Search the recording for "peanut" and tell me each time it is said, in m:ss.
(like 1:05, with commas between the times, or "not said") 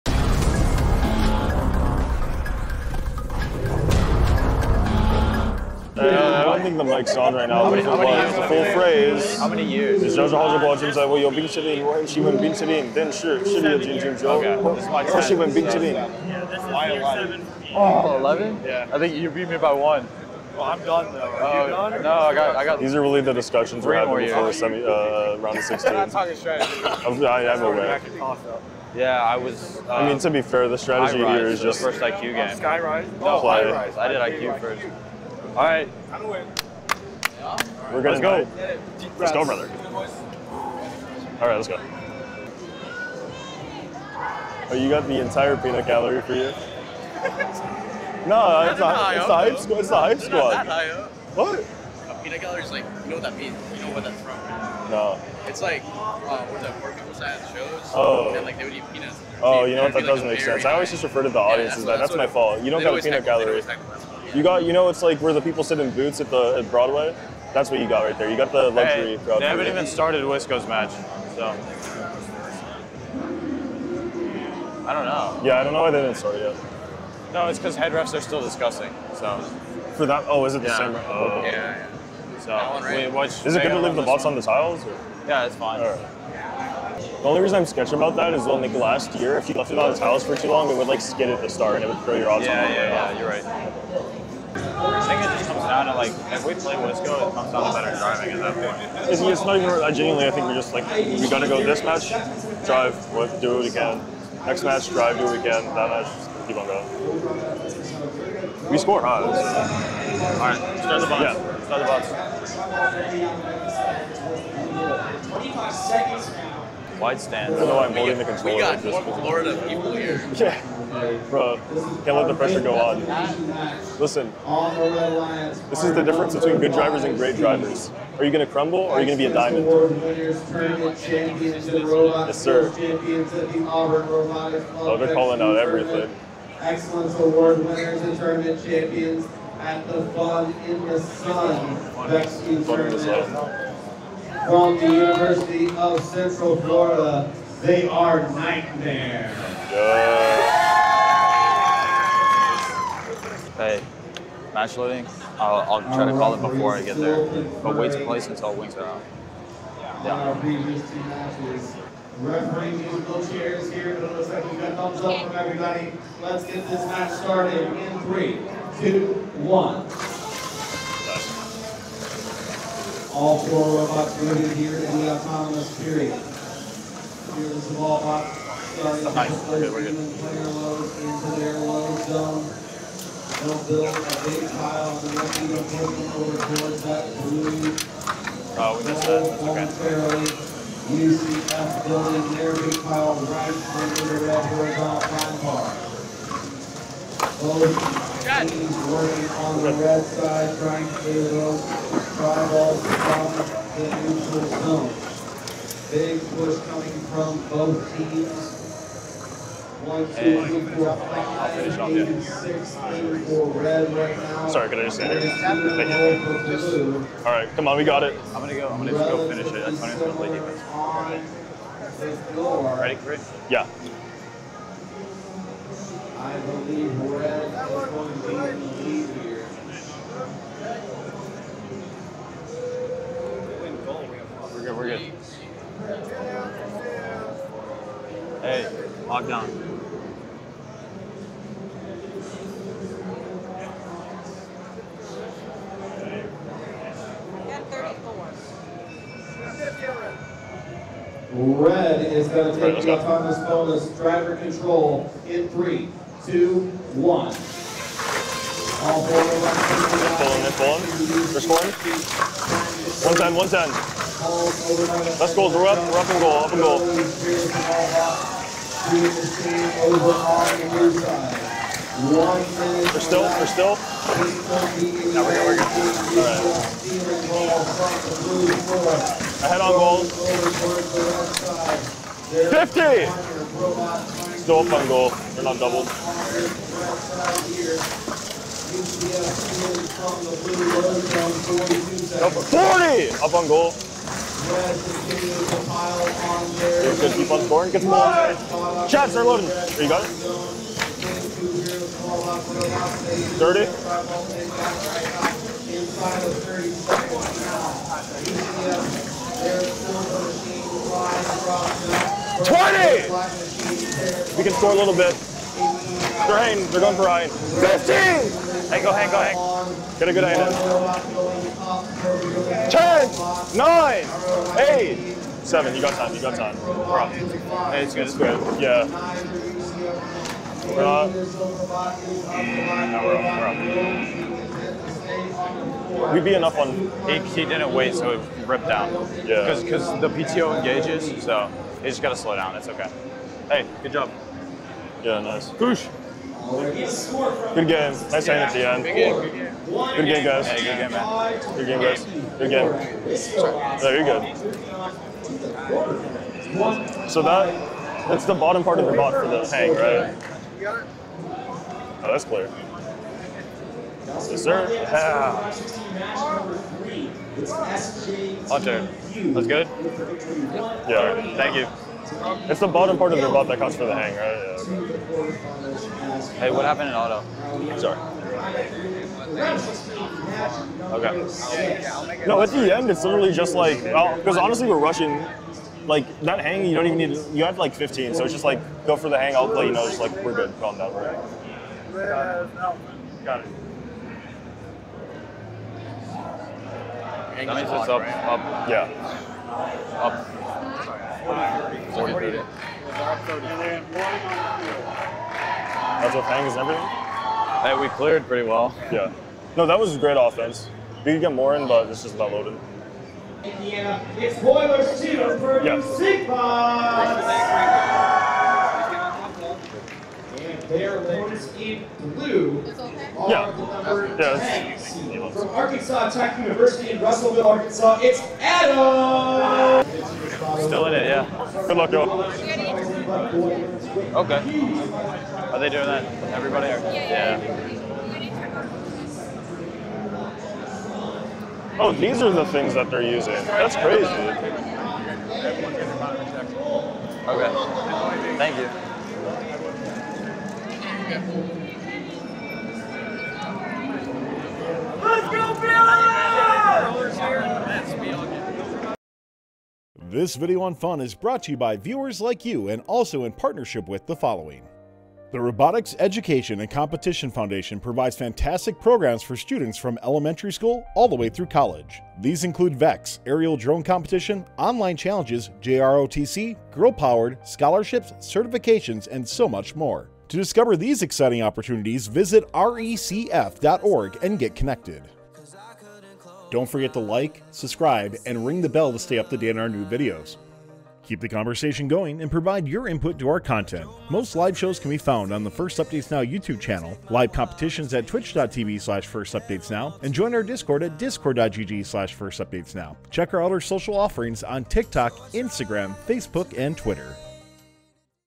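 0:45, 0:52, 0:58, 1:03.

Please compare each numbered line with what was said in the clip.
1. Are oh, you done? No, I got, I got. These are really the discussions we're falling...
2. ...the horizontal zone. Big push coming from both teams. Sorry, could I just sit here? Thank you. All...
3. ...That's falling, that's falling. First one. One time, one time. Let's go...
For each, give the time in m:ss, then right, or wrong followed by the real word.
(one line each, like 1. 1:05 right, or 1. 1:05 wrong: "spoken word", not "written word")
1. 0:21 wrong: "having", not "falling"
2. 3:23 wrong: "neutral", not "horizontal"
3. 4:20 right.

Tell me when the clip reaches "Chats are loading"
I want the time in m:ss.
4:58.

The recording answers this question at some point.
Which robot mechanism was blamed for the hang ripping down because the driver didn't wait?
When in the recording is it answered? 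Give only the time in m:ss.
5:40.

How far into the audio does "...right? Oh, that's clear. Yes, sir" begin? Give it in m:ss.
5:59.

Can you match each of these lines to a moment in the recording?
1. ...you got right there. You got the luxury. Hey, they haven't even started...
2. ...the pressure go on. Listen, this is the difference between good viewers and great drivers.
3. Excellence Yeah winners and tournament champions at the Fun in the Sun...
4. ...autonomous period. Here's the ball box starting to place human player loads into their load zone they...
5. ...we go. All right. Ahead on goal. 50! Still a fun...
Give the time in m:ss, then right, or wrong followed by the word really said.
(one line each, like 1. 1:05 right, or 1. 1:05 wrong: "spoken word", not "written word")
1. 1:07 right
2. 2:02 wrong: "drivers", not "viewers"
3. 2:16 wrong: "Award", not "Yeah"
4. 2:55 right
5. 4:38 right.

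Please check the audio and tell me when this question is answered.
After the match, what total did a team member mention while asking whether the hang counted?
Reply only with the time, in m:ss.
6:41.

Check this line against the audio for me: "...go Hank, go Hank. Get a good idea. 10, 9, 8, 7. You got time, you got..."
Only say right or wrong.
right.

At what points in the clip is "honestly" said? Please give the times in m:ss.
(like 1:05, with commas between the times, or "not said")
6:24.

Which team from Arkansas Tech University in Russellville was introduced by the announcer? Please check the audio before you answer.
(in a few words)
Adam.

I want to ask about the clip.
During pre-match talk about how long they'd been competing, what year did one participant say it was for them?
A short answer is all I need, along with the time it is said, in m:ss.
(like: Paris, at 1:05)
Year 7, at 0:16.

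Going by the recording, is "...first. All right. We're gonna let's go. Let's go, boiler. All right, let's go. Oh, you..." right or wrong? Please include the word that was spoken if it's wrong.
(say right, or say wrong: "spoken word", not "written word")
wrong: "brother", not "boiler".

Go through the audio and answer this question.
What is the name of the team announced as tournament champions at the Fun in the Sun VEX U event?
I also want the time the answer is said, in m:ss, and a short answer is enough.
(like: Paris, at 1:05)
Knightmare, at 2:28.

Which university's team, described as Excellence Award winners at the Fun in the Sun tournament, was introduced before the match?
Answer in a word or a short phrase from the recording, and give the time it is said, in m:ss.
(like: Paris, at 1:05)
University of Central Florida, at 2:24.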